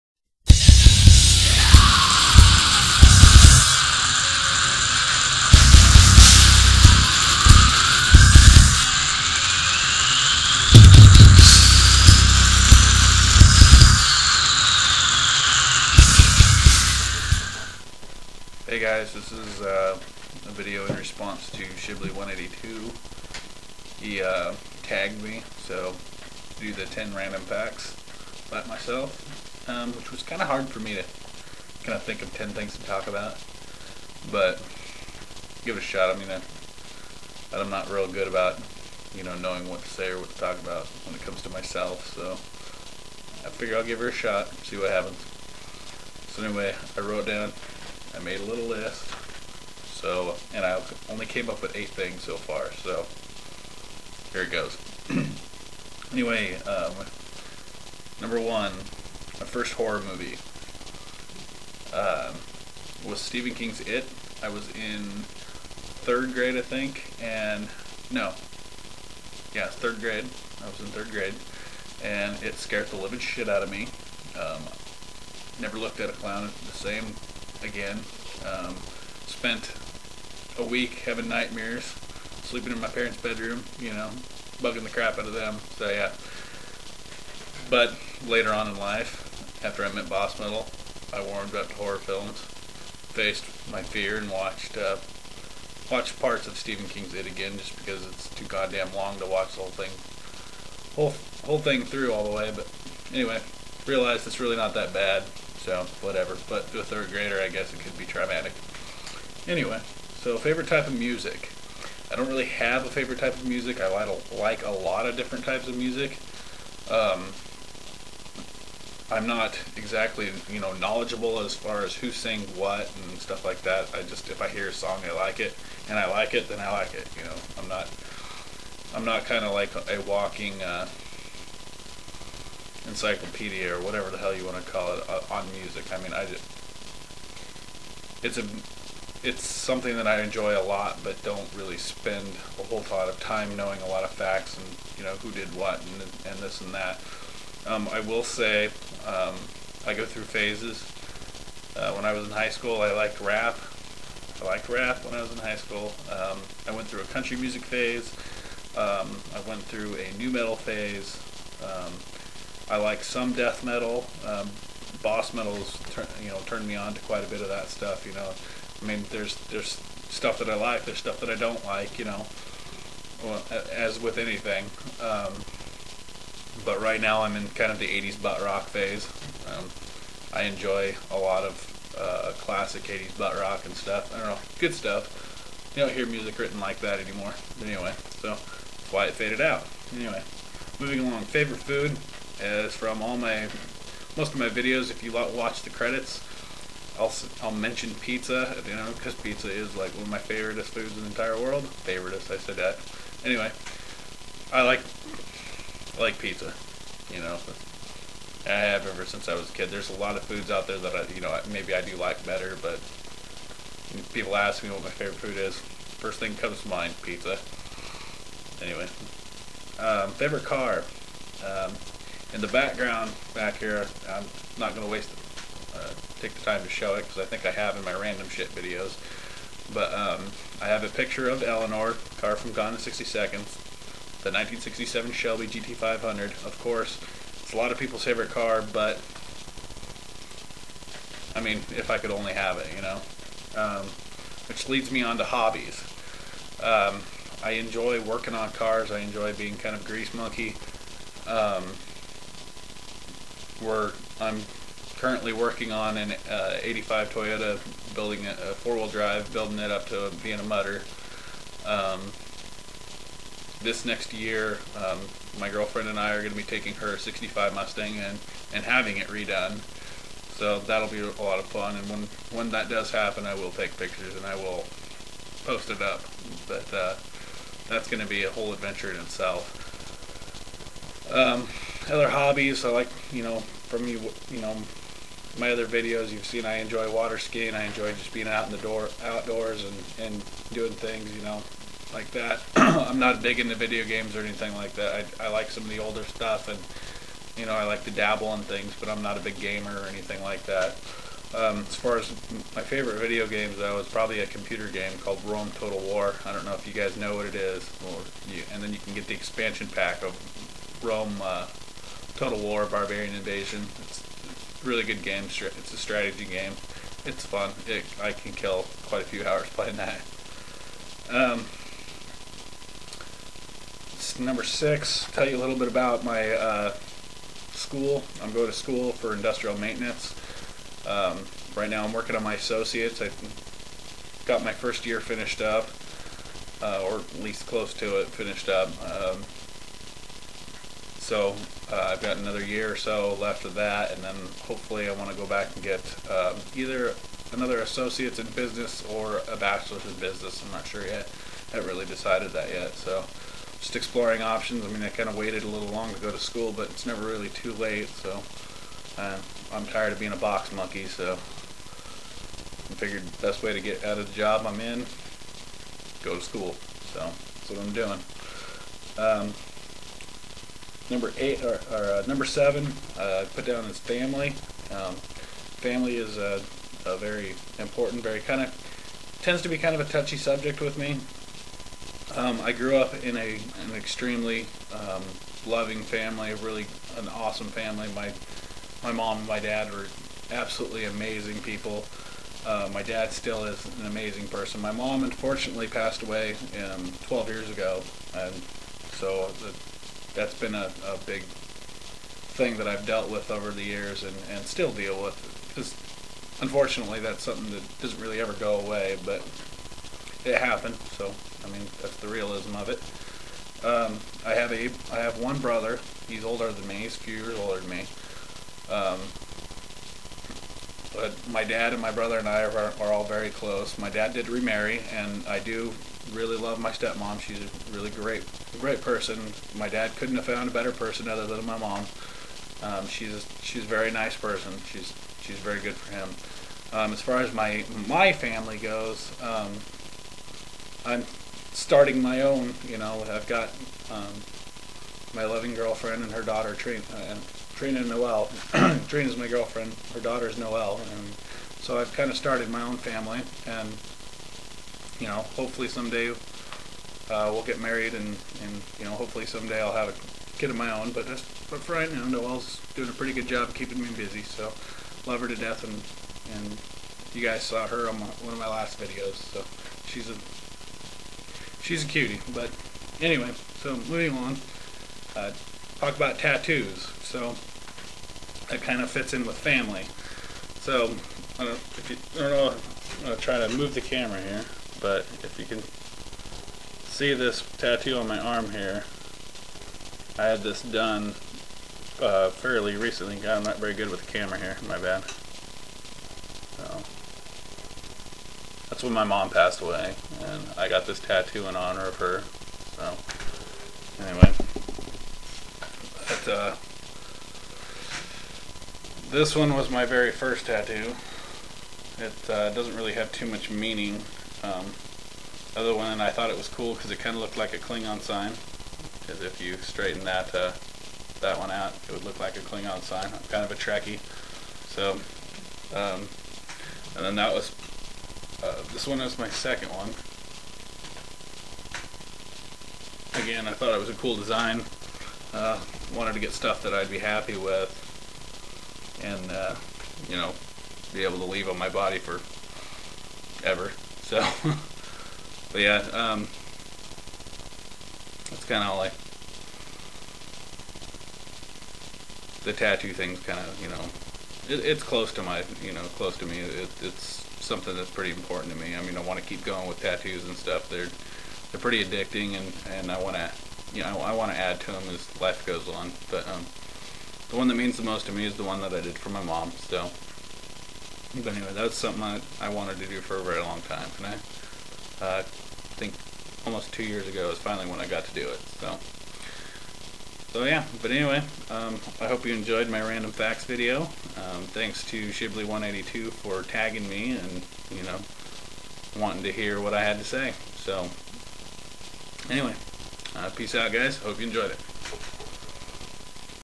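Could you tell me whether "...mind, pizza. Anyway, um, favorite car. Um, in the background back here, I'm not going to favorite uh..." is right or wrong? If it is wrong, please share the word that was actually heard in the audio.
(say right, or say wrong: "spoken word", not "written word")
wrong: "waste", not "favorite".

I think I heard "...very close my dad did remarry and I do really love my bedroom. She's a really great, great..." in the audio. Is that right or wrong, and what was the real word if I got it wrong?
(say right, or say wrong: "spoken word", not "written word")
wrong: "stepmom", not "bedroom".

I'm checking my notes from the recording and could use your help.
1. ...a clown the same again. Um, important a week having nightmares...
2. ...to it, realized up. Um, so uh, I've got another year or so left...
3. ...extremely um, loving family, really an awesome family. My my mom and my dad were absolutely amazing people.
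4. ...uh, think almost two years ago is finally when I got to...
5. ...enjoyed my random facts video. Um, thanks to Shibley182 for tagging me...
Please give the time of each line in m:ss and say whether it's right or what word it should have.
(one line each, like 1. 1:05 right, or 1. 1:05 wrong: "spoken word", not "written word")
1. 1:16 wrong: "spent", not "important"
2. 5:37 wrong: "finished", not "realized"
3. 6:23 right
4. 9:35 right
5. 9:42 right.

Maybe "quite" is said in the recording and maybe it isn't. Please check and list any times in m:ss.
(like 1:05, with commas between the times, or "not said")
2:47, 5:18.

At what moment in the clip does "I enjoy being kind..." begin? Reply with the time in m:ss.
4:08.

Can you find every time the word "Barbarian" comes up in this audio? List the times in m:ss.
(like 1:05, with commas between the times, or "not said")
5:12.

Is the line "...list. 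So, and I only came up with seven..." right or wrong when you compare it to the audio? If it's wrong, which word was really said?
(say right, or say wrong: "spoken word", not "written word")
wrong: "eight", not "seven".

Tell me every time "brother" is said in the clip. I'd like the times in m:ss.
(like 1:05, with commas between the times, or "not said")
6:55, 7:01.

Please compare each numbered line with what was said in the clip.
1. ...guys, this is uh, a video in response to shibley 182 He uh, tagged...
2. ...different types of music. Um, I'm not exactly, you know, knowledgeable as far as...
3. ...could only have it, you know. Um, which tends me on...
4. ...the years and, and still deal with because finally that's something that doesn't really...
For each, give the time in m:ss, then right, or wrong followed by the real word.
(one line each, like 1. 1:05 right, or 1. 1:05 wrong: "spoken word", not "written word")
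1. 0:18 right
2. 1:55 right
3. 4:01 wrong: "leads", not "tends"
4. 6:43 wrong: "unfortunately", not "finally".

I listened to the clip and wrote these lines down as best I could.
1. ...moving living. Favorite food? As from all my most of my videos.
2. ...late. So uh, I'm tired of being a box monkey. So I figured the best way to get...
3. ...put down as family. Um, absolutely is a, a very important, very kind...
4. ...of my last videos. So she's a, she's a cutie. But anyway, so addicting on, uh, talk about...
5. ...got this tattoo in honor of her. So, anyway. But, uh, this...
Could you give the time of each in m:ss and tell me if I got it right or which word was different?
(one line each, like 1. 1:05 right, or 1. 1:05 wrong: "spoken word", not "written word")
1. 3:10 wrong: "along", not "living"
2. 5:57 right
3. 6:13 wrong: "family", not "absolutely"
4. 7:48 wrong: "moving", not "addicting"
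5. 8:20 right.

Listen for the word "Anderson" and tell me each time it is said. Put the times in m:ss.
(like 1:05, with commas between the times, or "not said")
not said.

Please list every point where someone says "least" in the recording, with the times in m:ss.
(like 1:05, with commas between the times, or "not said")
5:37.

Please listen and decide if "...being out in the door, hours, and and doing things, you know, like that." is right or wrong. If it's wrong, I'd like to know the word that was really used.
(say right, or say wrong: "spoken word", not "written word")
wrong: "outdoors", not "hours".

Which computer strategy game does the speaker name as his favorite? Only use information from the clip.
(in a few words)
Rome Total War.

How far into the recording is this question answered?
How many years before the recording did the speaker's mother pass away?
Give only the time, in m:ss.
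6:37.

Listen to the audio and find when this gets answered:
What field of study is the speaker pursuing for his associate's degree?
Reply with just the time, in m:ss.
5:29.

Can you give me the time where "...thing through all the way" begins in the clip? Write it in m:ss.
1:41.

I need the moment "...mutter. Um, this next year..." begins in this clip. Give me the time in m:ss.
4:20.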